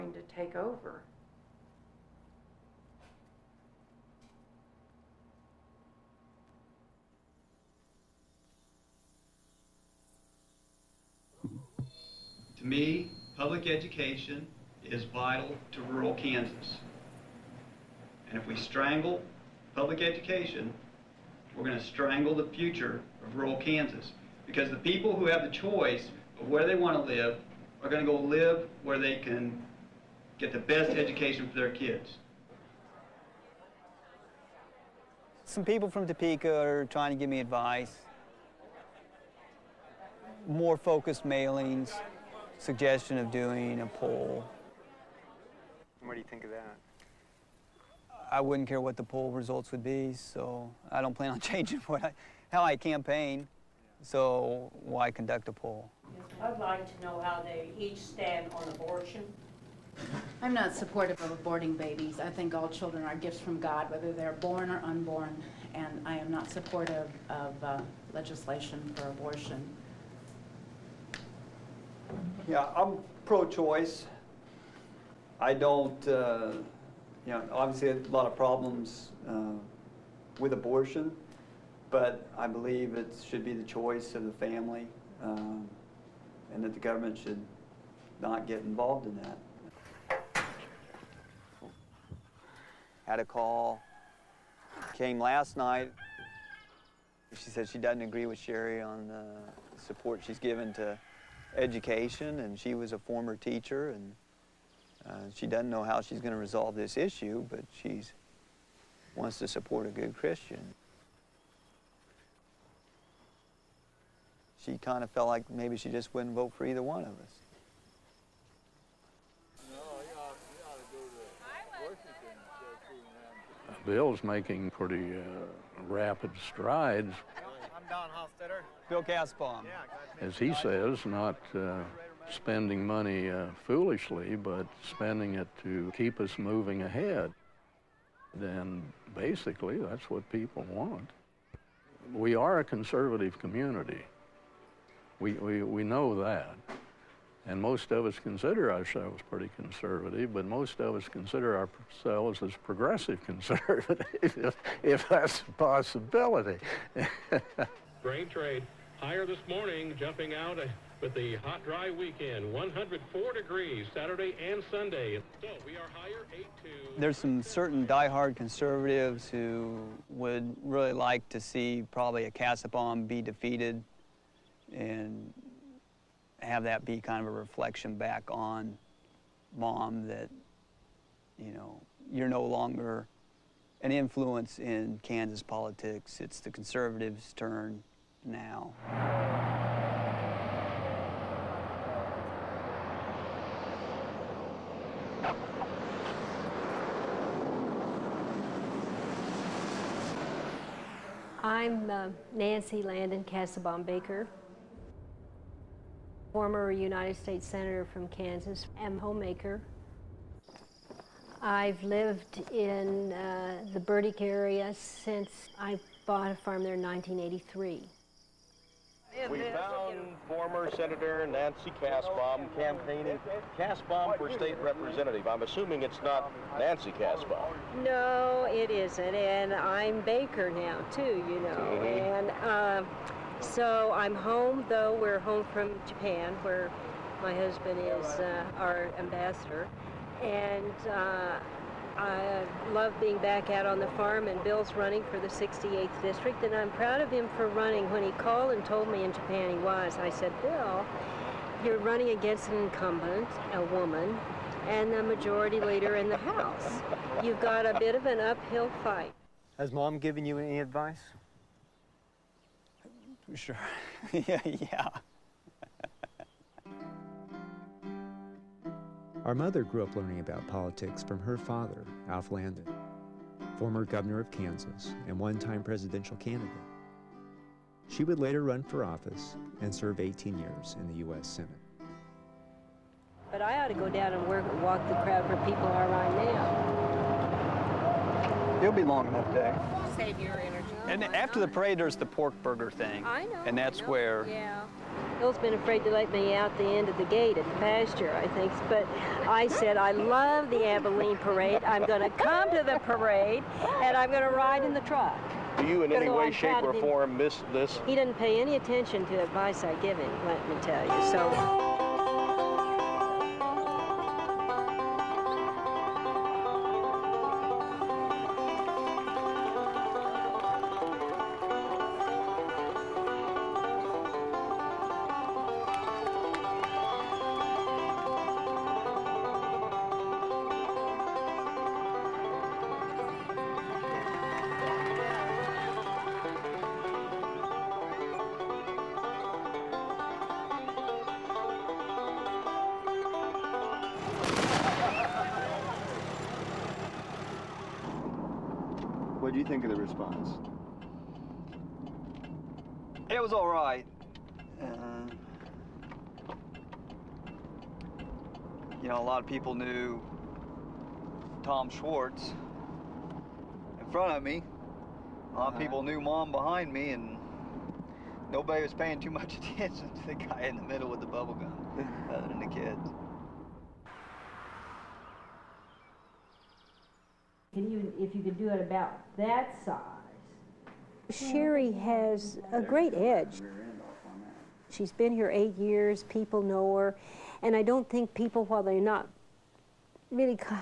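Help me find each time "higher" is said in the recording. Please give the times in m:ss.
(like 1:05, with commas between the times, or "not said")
2:38, 2:45.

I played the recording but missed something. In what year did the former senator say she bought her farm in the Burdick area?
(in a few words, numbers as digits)
1983.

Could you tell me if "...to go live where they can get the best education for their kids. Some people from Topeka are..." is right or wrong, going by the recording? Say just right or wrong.
right.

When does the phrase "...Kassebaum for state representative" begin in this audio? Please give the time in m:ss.
3:43.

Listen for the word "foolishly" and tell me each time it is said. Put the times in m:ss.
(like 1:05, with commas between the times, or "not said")
2:13.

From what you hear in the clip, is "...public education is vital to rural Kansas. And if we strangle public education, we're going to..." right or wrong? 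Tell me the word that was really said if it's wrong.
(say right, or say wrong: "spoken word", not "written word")
right.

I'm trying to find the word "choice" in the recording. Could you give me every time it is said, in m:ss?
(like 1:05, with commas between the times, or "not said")
0:25, 1:13, 1:23.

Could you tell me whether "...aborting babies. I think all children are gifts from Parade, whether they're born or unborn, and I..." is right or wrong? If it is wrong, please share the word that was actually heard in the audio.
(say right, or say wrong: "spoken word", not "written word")
wrong: "God", not "Parade".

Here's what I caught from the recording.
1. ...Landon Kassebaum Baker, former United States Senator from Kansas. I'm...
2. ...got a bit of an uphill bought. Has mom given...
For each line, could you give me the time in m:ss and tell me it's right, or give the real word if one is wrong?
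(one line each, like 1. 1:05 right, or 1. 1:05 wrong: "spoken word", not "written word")
1. 3:22 right
2. 4:17 wrong: "fight", not "bought".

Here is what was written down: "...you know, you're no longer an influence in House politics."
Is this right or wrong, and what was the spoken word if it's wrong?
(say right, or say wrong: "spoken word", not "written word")
wrong: "Kansas", not "House".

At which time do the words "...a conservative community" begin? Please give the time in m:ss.
2:22.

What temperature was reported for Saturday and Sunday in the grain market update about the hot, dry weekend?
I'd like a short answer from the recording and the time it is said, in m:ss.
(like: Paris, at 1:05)
104 degrees, at 2:42.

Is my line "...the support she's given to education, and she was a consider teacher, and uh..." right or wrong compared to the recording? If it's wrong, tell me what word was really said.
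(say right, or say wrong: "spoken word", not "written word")
wrong: "former", not "consider".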